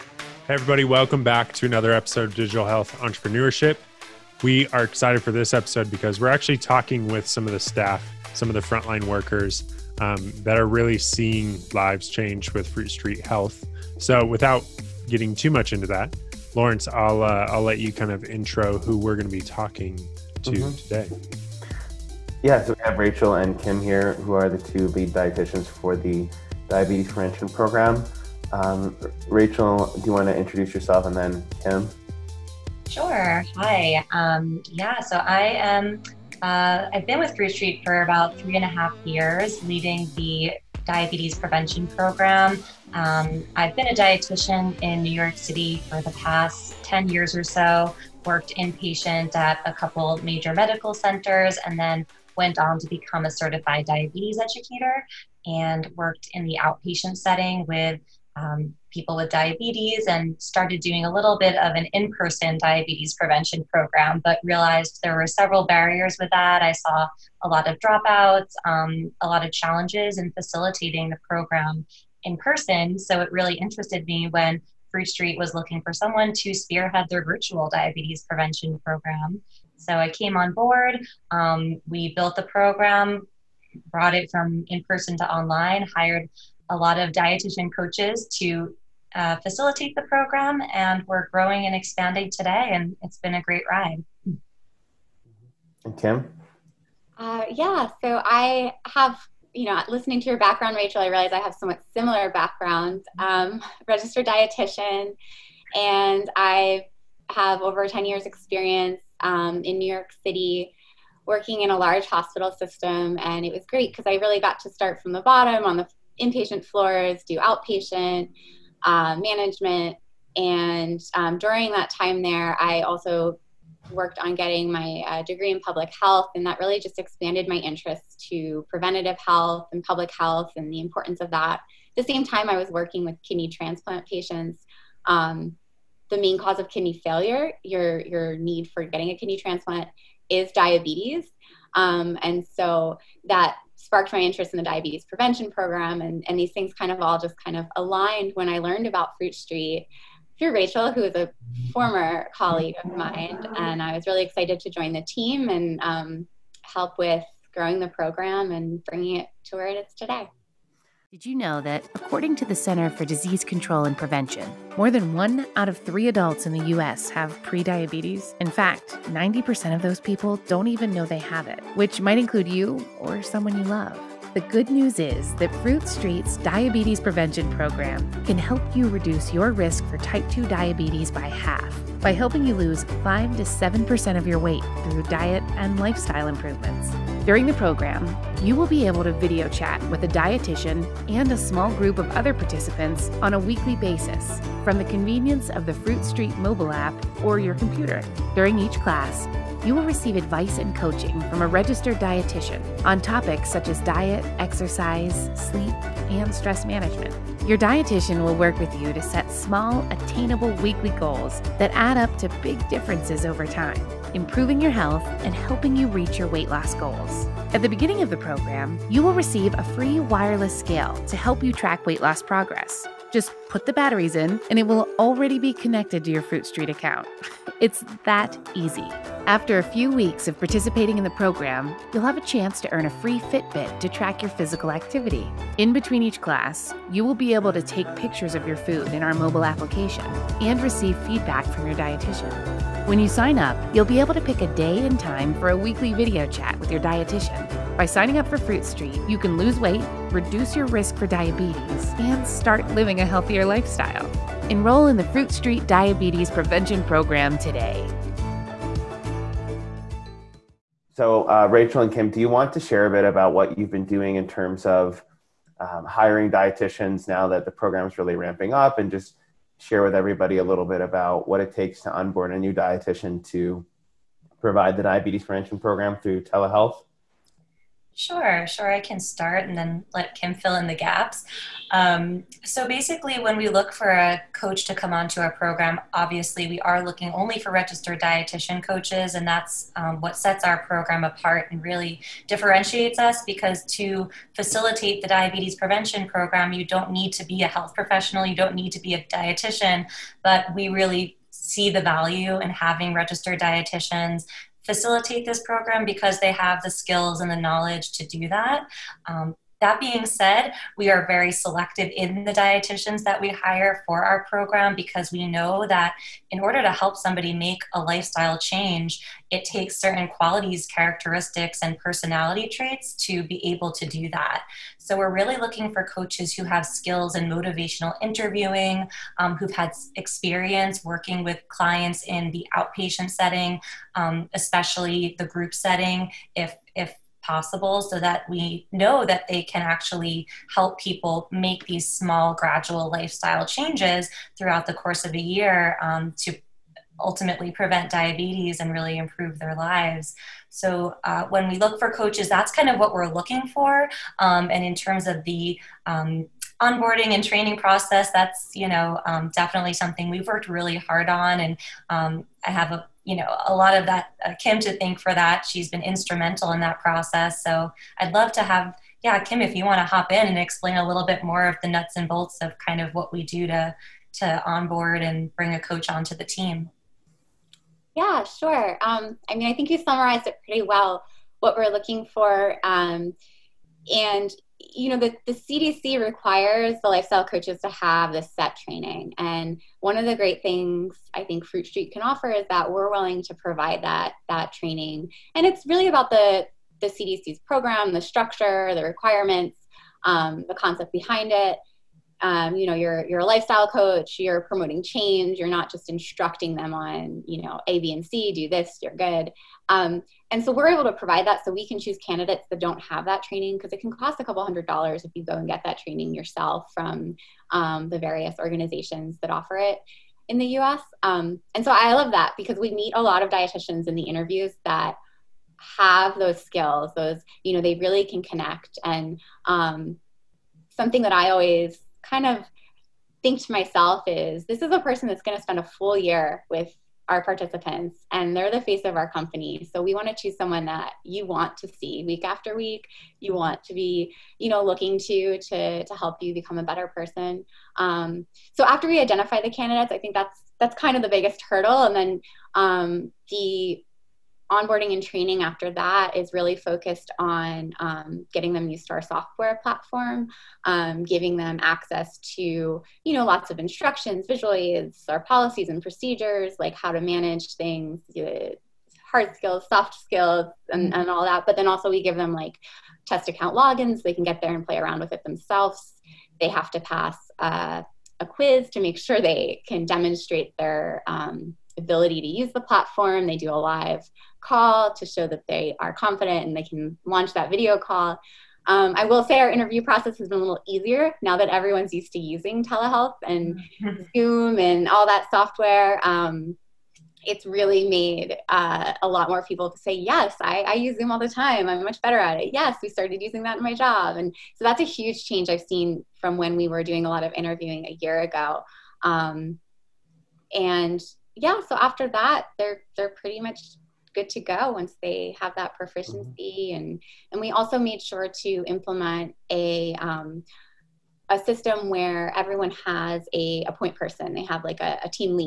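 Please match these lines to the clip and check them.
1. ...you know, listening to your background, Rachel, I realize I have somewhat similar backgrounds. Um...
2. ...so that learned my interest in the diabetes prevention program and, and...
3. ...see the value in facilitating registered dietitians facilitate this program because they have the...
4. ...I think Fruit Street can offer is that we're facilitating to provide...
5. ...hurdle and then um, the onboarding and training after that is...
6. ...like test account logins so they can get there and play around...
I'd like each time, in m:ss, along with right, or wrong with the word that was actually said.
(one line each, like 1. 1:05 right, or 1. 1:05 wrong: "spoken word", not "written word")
1. 1:39 right
2. 2:22 wrong: "sparked", not "learned"
3. 5:01 wrong: "having", not "facilitating"
4. 6:31 wrong: "willing", not "facilitating"
5. 7:31 right
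6. 7:52 right.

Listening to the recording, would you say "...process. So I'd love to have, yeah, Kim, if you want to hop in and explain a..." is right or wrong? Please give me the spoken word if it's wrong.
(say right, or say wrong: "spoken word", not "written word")
right.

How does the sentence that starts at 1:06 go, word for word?
I saw a lot of dropouts, um, a lot of challenges in facilitating the program in person.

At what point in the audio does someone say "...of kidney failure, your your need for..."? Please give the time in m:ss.
2:16.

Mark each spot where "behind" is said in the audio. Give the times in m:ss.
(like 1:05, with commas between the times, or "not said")
6:40.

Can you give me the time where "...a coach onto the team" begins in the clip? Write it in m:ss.
6:15.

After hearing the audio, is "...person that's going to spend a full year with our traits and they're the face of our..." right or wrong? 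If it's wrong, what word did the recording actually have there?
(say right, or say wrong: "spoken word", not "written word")
wrong: "participants", not "traits".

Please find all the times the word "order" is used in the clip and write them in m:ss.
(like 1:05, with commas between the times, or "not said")
5:16.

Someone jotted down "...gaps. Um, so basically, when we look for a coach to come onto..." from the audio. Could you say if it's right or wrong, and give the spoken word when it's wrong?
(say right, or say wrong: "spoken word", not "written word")
right.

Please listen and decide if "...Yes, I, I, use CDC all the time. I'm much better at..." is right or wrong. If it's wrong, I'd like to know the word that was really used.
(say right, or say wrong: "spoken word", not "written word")
wrong: "Zoom", not "CDC".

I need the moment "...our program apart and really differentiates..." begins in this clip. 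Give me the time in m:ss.
4:50.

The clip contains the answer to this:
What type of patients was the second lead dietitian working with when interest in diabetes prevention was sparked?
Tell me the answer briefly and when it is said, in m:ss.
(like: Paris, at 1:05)
kidney transplant patients, at 2:13.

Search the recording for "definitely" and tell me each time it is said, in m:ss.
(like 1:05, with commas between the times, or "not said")
5:59.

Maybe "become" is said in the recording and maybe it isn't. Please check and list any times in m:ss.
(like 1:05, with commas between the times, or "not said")
0:52, 7:26.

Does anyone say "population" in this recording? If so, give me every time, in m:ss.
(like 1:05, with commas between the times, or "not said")
not said.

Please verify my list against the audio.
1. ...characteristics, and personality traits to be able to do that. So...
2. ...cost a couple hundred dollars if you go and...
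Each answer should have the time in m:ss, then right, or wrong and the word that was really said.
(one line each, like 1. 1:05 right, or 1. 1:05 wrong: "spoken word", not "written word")
1. 5:20 right
2. 6:53 right.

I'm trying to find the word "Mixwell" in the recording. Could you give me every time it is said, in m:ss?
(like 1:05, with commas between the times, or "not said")
not said.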